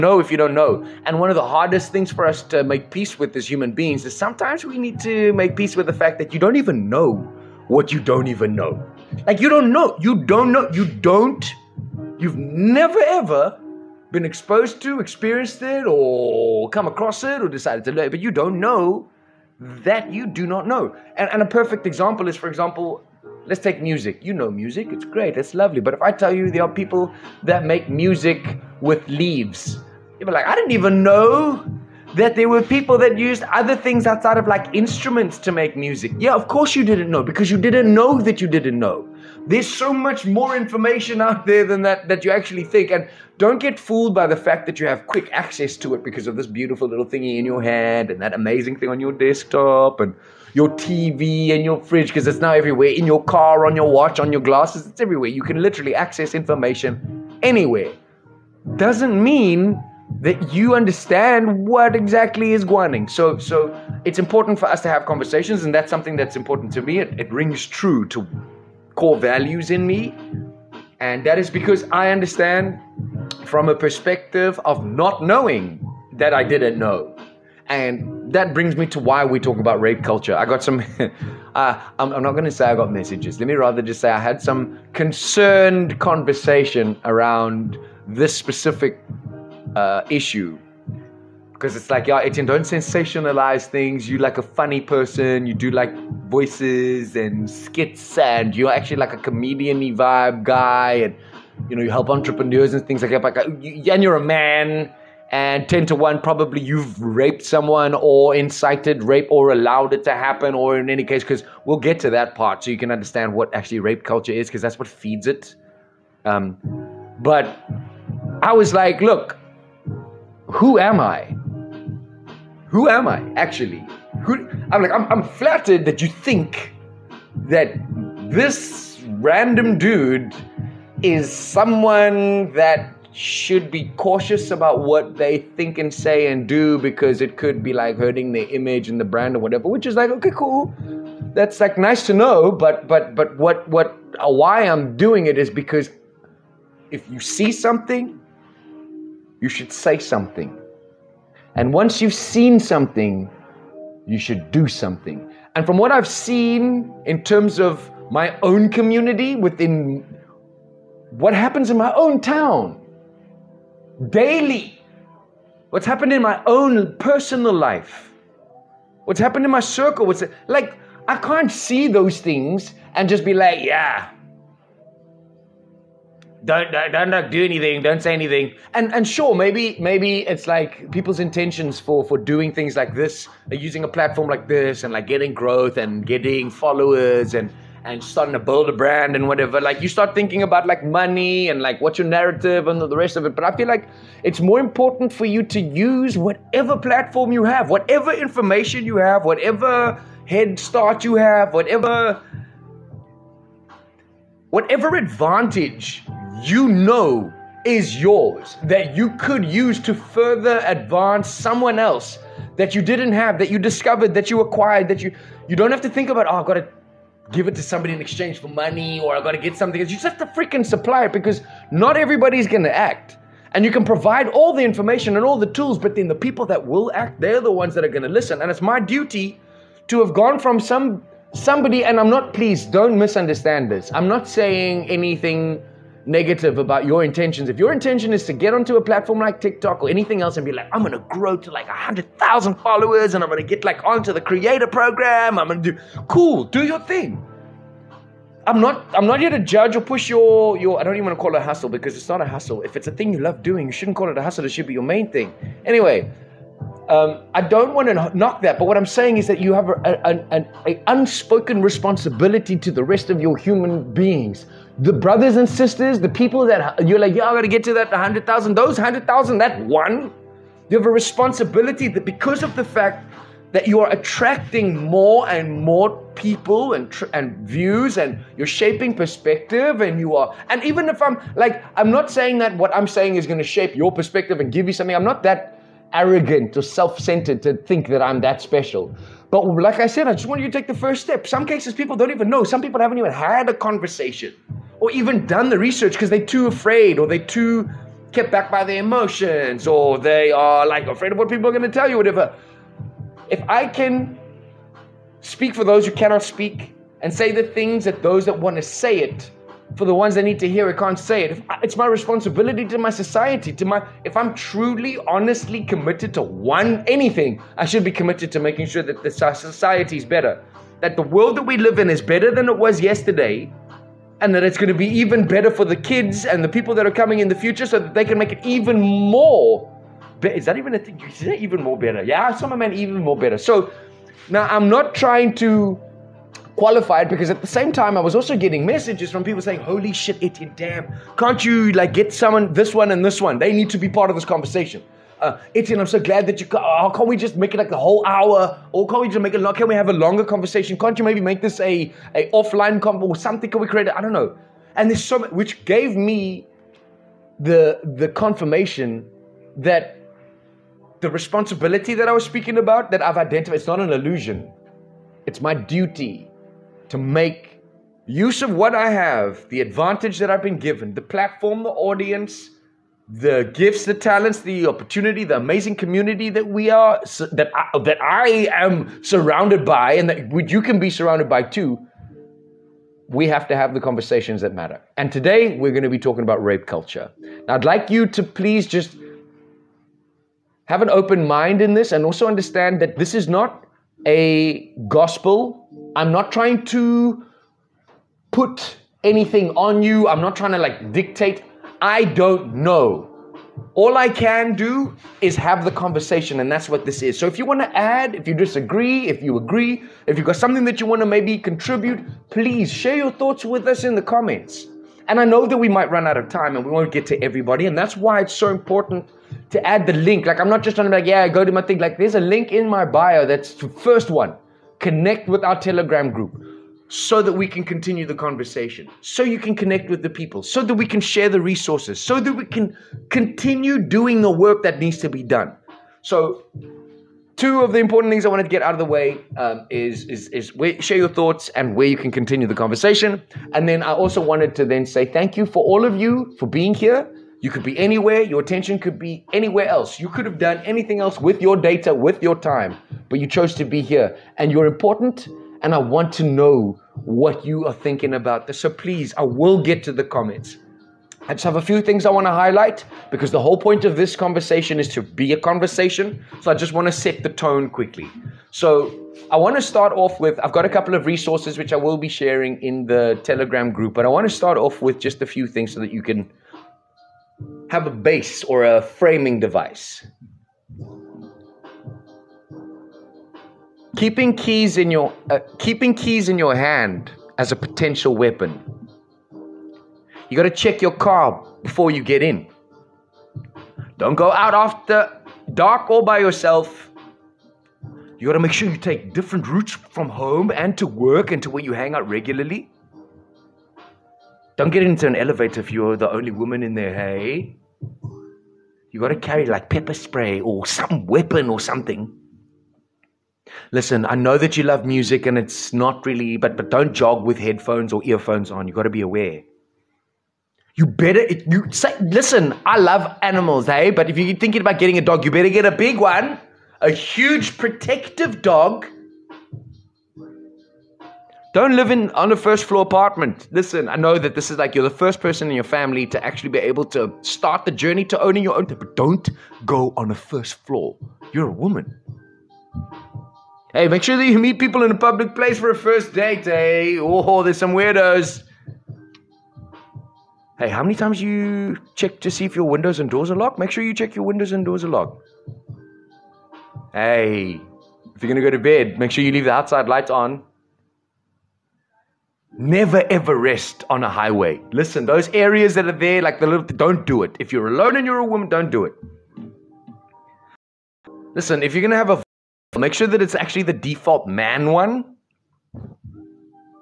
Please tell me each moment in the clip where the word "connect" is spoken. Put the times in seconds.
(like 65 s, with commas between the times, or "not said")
424 s, 429 s.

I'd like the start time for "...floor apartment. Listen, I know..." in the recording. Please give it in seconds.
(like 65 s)
532 s.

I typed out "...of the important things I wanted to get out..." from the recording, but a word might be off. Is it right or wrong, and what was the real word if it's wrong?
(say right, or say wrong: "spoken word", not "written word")
right.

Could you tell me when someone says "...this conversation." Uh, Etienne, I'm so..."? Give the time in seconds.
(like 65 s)
344 s.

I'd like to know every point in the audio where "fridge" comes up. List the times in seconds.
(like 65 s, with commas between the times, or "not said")
51 s.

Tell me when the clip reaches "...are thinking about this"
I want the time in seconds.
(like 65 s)
457 s.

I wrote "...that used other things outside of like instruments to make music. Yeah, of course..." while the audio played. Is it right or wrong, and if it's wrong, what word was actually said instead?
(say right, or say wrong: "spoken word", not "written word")
right.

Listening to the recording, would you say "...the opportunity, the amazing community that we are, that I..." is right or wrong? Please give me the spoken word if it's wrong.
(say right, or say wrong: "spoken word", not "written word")
right.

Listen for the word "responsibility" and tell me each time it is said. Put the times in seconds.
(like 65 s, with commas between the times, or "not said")
261 s, 270 s, 311 s, 361 s.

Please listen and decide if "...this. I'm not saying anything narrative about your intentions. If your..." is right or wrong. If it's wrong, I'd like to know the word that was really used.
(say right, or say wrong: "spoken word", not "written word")
wrong: "negative", not "narrative".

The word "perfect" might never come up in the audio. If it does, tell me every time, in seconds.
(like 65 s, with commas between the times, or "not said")
21 s.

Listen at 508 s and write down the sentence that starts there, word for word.
You gotta carry like pepper spray or some weapon or something.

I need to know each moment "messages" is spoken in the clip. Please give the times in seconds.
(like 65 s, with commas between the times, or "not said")
82 s, 338 s.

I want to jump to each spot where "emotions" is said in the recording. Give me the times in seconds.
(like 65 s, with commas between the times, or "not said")
298 s.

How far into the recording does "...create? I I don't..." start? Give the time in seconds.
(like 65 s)
353 s.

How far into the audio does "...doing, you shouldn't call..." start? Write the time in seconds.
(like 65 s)
253 s.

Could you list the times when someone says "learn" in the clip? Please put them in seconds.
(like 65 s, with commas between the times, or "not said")
17 s.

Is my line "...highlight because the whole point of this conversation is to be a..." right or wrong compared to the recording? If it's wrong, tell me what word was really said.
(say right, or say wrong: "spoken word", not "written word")
right.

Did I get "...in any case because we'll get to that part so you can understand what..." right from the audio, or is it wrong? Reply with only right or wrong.
right.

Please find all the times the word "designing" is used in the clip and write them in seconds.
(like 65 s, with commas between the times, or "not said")
not said.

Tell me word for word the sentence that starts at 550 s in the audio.
Hey, how many times you check to see if your windows and doors are locked?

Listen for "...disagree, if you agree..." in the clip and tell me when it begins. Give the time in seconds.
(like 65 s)
408 s.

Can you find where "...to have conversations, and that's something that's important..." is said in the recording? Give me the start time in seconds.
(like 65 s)
64 s.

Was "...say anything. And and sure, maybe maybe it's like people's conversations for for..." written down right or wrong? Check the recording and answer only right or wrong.
wrong.